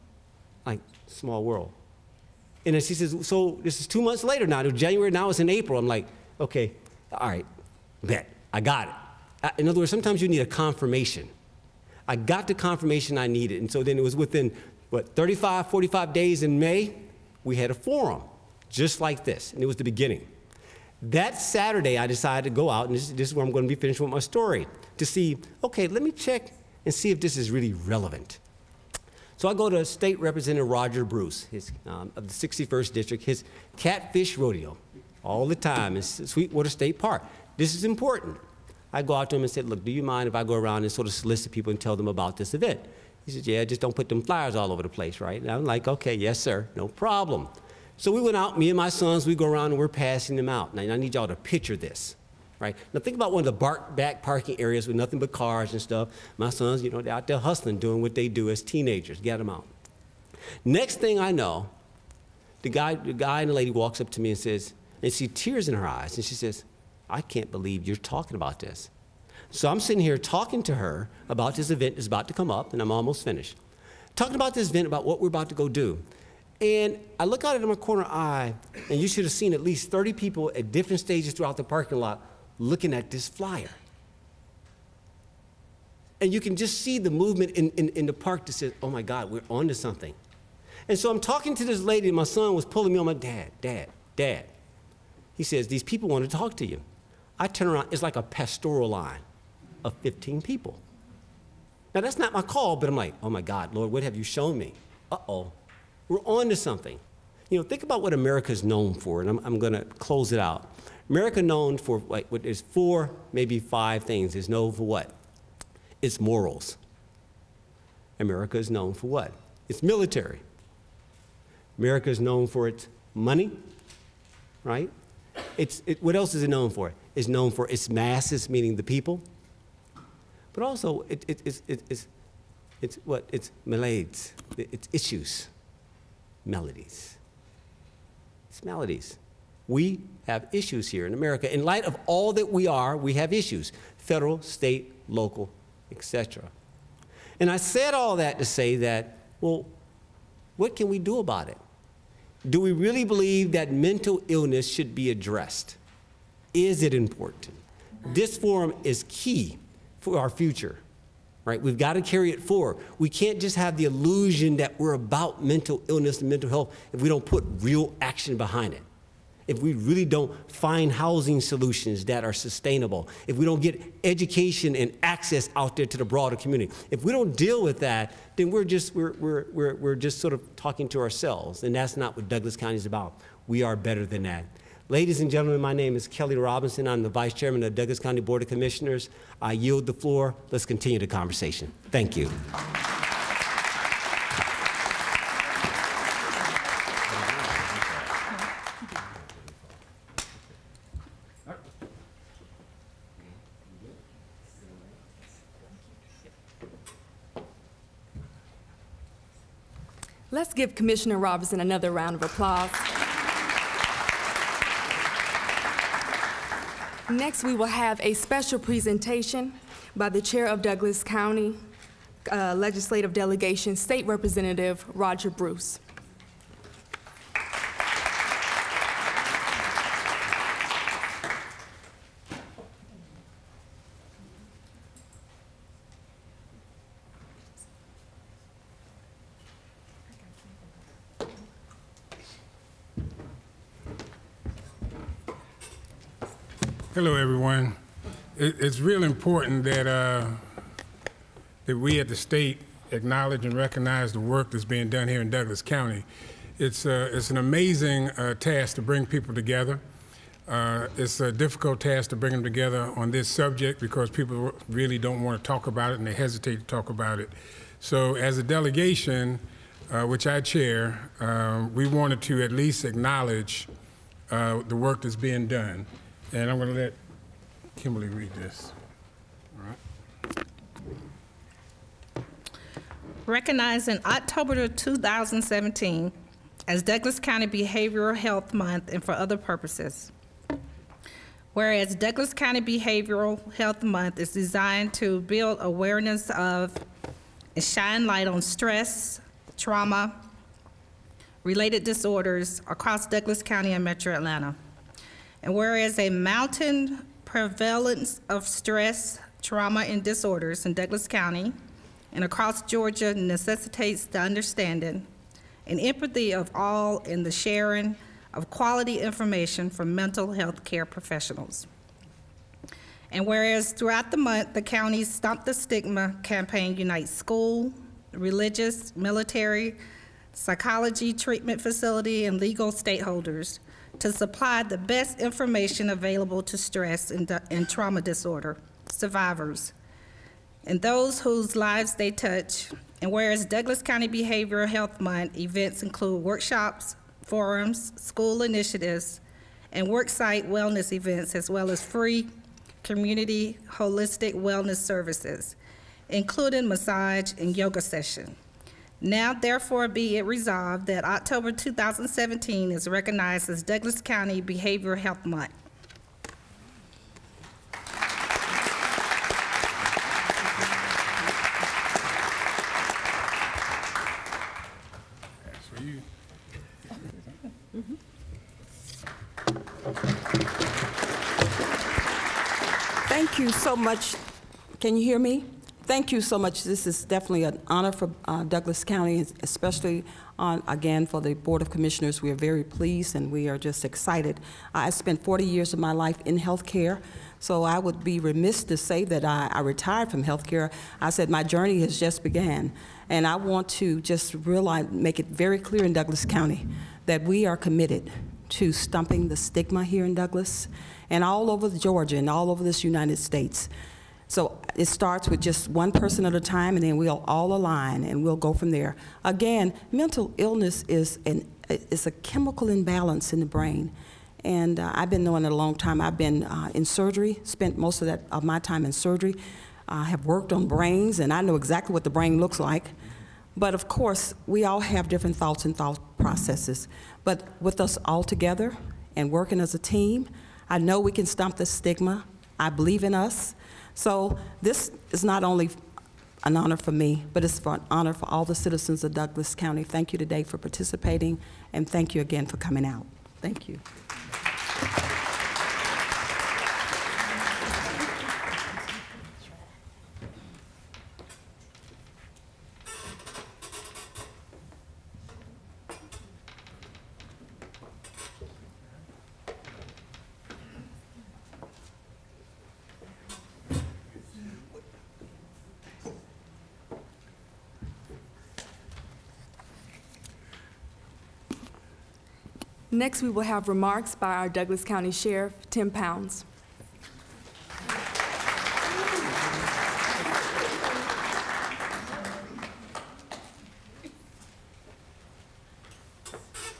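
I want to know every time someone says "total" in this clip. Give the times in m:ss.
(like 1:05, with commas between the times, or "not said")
not said.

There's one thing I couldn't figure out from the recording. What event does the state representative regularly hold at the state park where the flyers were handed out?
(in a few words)
catfish rodeo.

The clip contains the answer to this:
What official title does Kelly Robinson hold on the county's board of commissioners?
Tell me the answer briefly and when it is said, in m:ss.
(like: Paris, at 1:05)
Vice Chairman, at 3:07.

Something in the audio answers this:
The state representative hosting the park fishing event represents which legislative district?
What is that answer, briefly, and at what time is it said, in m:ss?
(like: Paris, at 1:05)
61st District, at 0:32.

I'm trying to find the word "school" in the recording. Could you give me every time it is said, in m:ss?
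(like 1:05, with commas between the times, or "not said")
5:27, 5:48.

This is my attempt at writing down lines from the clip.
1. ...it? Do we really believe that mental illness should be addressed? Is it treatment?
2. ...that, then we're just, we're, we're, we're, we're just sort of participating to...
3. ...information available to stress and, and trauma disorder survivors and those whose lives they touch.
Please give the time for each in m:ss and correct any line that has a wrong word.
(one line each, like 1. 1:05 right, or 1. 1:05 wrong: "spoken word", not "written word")
1. 2:31 wrong: "important", not "treatment"
2. 2:57 wrong: "talking", not "participating"
3. 5:35 right.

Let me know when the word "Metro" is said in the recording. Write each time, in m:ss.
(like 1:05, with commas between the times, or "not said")
5:03.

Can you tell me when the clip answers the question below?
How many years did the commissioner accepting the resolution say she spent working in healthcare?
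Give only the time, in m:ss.
6:35.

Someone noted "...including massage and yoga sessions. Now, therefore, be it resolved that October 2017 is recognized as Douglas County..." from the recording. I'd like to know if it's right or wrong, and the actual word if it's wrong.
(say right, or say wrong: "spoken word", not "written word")
right.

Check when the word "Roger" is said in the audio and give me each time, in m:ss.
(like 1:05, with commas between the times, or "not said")
0:30, 3:44.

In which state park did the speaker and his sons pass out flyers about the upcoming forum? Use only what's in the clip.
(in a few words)
Sweetwater State Park.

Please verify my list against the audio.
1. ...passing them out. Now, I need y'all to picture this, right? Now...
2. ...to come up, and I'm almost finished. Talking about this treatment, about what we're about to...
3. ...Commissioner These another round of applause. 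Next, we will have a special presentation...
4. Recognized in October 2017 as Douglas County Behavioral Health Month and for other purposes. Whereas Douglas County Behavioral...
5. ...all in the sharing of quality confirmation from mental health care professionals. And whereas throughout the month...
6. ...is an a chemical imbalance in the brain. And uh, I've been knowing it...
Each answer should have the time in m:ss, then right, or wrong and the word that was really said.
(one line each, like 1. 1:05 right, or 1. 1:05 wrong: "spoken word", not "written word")
1. 0:49 right
2. 1:12 wrong: "event", not "treatment"
3. 3:30 wrong: "Robinson", not "These"
4. 4:43 right
5. 5:16 wrong: "information", not "confirmation"
6. 7:00 right.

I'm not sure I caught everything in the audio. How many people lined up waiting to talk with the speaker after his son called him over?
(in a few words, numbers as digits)
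15.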